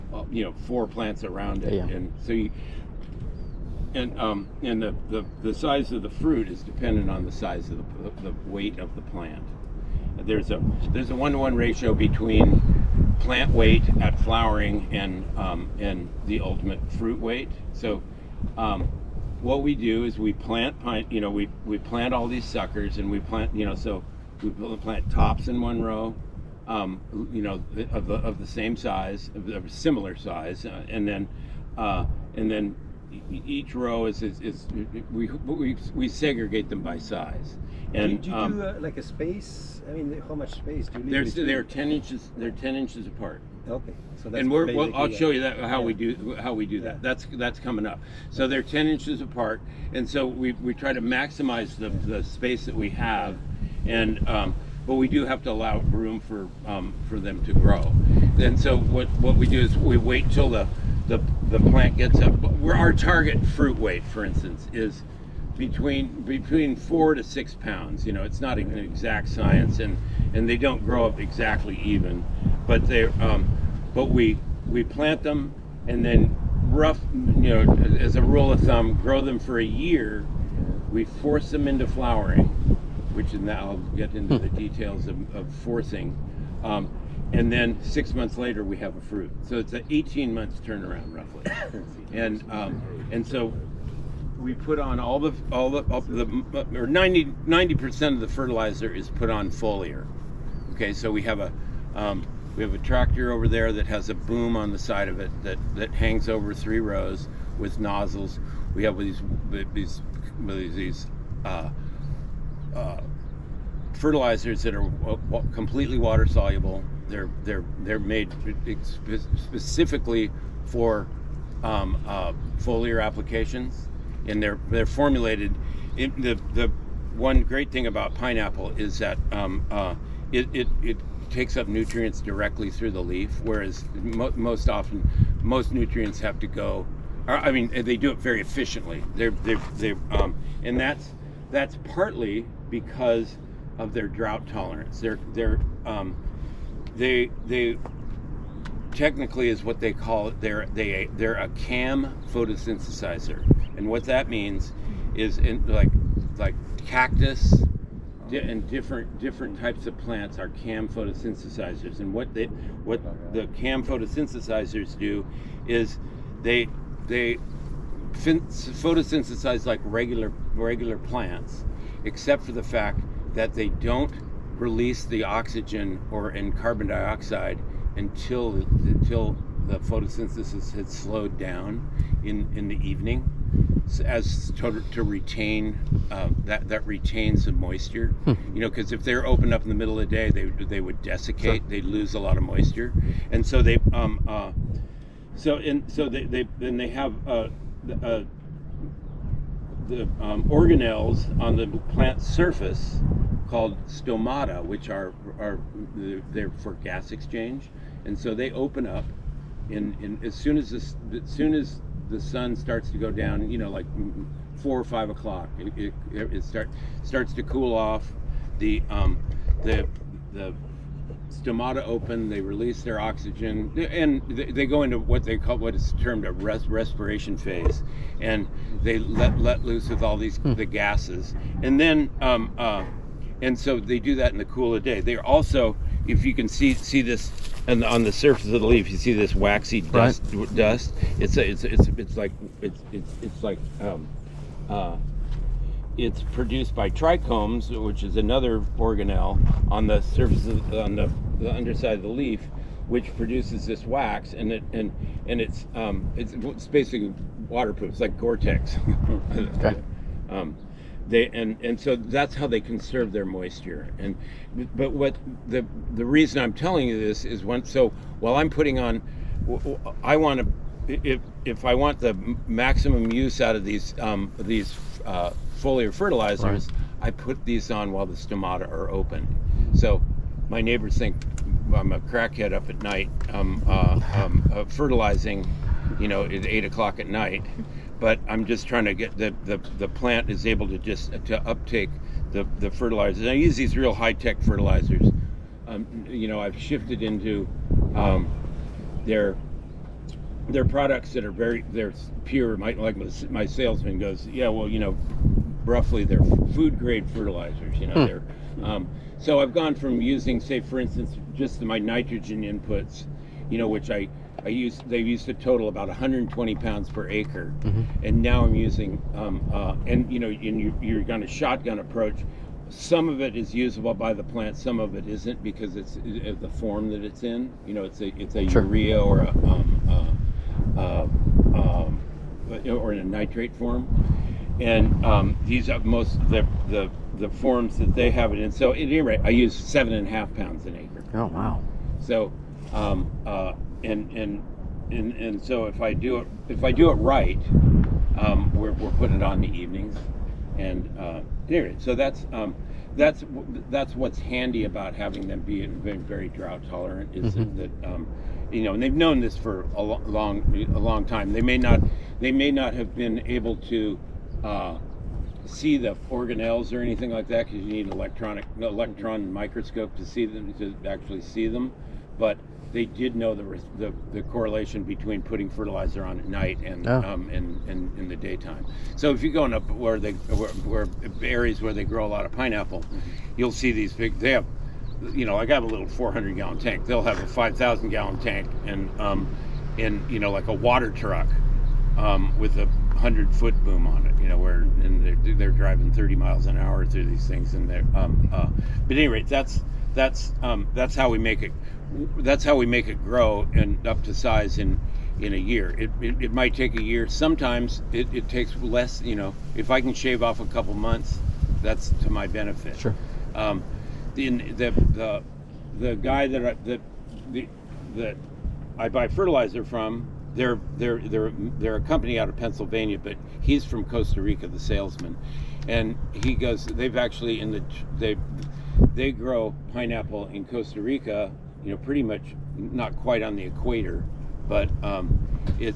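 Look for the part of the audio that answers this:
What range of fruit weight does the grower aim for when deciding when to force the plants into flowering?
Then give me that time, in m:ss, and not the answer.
1:06.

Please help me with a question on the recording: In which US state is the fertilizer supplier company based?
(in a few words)
Pennsylvania.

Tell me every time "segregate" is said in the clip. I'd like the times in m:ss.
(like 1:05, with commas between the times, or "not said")
0:36.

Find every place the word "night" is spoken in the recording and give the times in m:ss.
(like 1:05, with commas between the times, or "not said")
4:42, 4:47, 6:16.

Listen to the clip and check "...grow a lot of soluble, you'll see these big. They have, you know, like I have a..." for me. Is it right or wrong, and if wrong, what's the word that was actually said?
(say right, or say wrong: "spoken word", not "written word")
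wrong: "pineapple", not "soluble".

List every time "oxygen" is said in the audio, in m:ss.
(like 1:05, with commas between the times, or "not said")
2:55, 3:43.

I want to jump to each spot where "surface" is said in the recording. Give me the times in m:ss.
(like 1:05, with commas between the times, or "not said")
3:22, 3:58, 4:10.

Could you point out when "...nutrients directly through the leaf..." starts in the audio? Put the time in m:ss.
2:11.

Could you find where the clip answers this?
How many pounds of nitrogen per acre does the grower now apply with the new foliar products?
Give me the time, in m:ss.
5:39.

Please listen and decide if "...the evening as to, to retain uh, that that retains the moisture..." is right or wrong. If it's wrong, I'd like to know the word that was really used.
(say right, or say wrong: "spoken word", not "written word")
right.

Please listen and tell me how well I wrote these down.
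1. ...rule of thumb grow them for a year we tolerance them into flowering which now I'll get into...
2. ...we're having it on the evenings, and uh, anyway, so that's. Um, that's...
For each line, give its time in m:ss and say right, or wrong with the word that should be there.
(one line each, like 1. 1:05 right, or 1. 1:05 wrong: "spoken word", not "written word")
1. 1:18 wrong: "force", not "tolerance"
2. 5:48 wrong: "putting", not "having".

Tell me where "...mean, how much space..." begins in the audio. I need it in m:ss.
0:39.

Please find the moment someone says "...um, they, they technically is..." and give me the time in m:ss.
2:25.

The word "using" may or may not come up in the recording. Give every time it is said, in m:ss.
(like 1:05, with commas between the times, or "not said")
5:10, 5:18.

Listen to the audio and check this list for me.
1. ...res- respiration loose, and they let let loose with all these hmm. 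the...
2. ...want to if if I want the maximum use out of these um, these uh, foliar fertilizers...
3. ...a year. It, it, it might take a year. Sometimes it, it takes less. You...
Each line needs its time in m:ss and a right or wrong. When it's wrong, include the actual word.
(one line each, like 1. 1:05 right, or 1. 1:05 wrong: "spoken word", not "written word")
1. 3:46 wrong: "phase", not "loose"
2. 4:30 right
3. 6:45 right.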